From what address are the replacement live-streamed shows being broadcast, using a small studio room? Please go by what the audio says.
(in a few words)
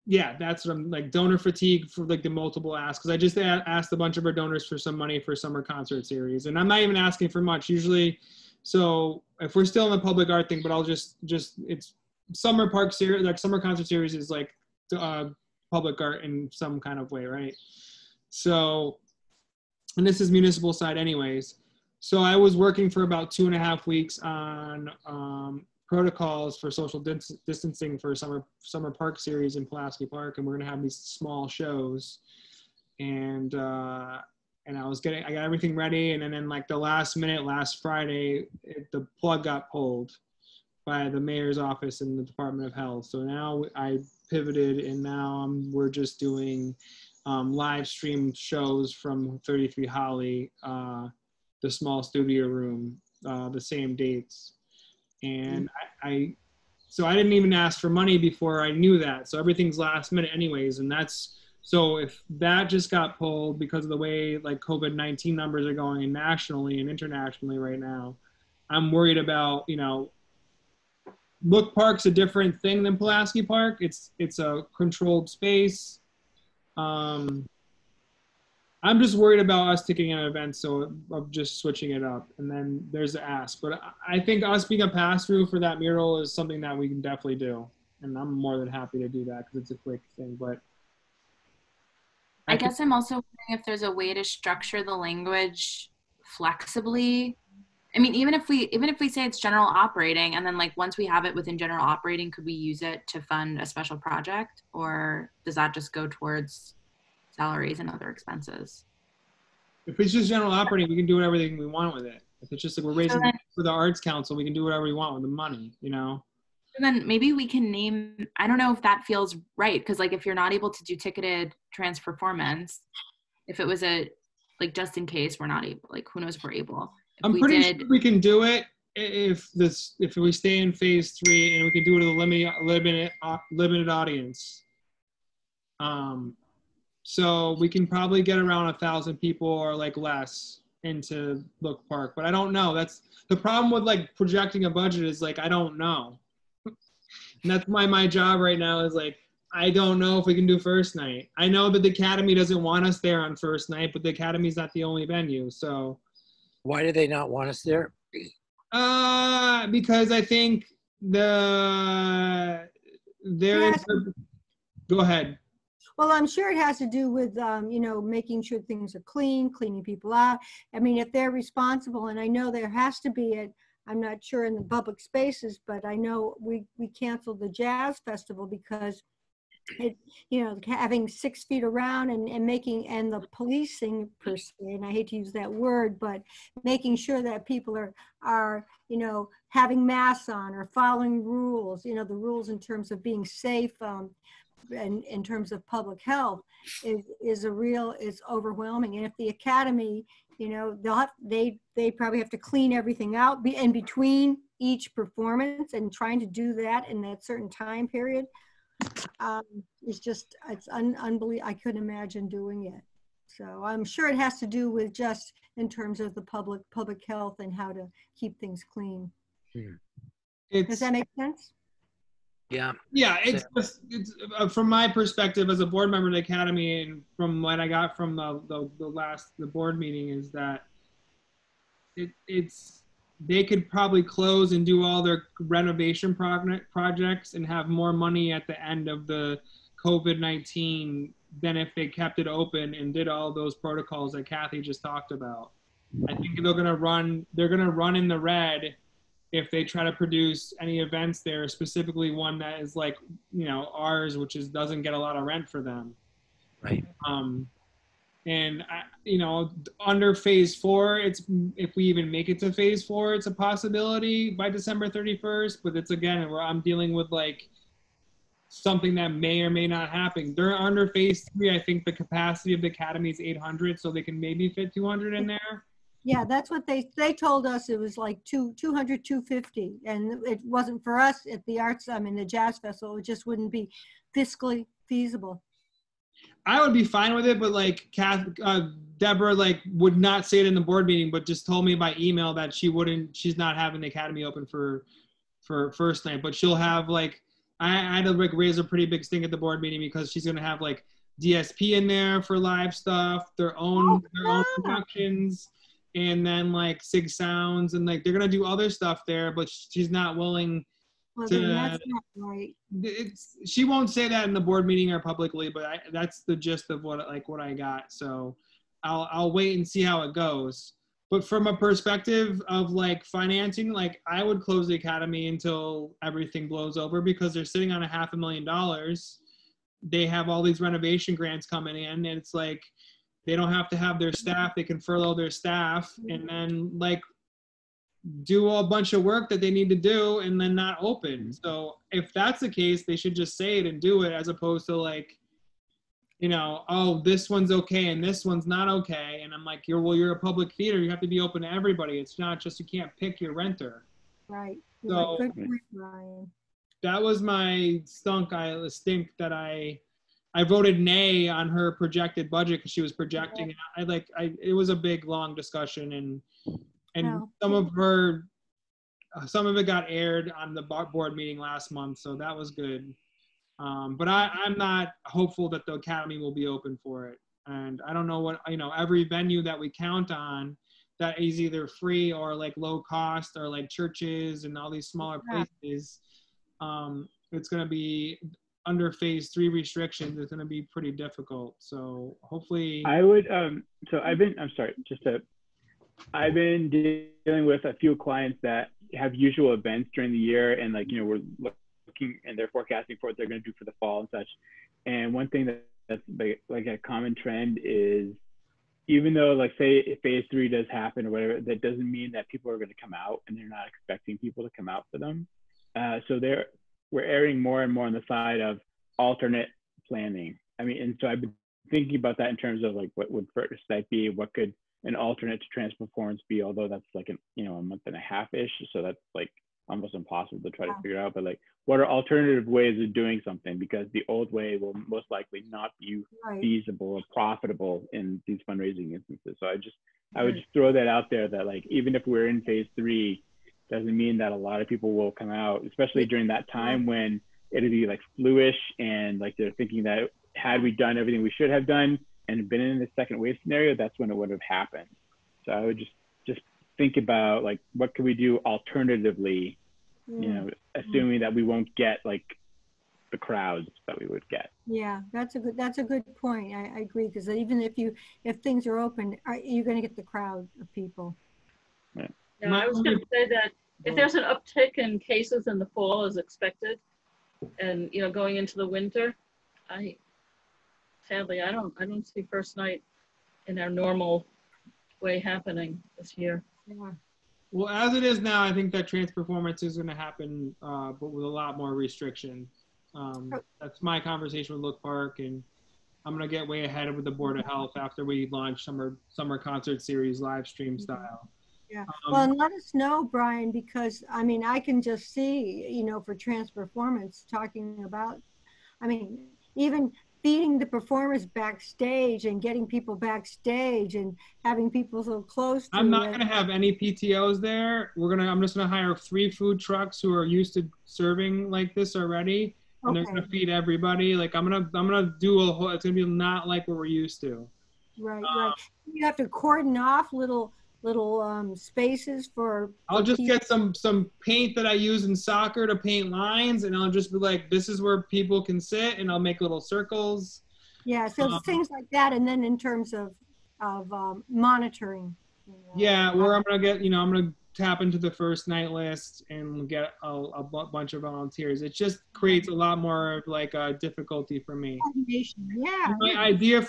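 33 Hawley.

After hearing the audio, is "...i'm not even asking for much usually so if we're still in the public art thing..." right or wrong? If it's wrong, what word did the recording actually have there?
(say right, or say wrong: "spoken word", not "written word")
right.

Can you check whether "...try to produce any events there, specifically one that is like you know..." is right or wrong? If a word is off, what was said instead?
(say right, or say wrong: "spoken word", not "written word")
right.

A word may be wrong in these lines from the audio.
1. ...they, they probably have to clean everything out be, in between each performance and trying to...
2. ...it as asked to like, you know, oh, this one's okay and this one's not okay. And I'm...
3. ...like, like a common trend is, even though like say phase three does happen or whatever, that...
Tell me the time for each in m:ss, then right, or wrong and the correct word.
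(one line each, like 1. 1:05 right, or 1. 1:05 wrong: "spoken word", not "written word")
1. 3:21 right
2. 5:44 wrong: "opposed", not "asked"
3. 6:46 right.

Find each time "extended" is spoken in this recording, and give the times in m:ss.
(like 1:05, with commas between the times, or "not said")
not said.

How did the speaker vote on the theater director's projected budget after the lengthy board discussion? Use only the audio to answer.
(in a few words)
nay.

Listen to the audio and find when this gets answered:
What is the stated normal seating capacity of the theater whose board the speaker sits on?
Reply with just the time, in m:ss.
4:33.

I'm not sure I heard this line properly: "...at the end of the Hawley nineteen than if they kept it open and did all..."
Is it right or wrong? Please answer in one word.
wrong.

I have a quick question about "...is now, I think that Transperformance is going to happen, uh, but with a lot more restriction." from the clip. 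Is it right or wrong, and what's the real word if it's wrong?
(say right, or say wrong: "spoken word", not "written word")
right.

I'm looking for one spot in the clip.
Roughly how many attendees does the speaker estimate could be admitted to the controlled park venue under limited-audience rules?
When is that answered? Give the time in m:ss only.
2:18.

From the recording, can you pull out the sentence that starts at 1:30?
But I, I guess I'm also wondering if there's a way to structure the language flexibly.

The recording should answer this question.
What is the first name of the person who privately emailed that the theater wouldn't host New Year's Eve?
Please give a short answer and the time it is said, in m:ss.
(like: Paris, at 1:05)
Deborah, at 4:48.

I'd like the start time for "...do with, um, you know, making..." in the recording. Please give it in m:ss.
2:46.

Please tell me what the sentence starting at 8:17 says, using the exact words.
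Health after we launch summer summer concert series live stream mm-hmm.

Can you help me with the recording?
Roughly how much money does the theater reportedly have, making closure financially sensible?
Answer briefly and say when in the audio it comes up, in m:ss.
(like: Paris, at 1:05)
half a million dollars, at 5:27.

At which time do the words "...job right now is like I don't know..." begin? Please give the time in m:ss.
2:28.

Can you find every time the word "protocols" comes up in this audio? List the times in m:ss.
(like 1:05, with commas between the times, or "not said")
0:25, 4:03.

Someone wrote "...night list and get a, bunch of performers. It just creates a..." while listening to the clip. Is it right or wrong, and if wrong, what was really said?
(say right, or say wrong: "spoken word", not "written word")
wrong: "volunteers", not "performers".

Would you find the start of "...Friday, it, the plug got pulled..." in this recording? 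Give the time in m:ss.
0:37.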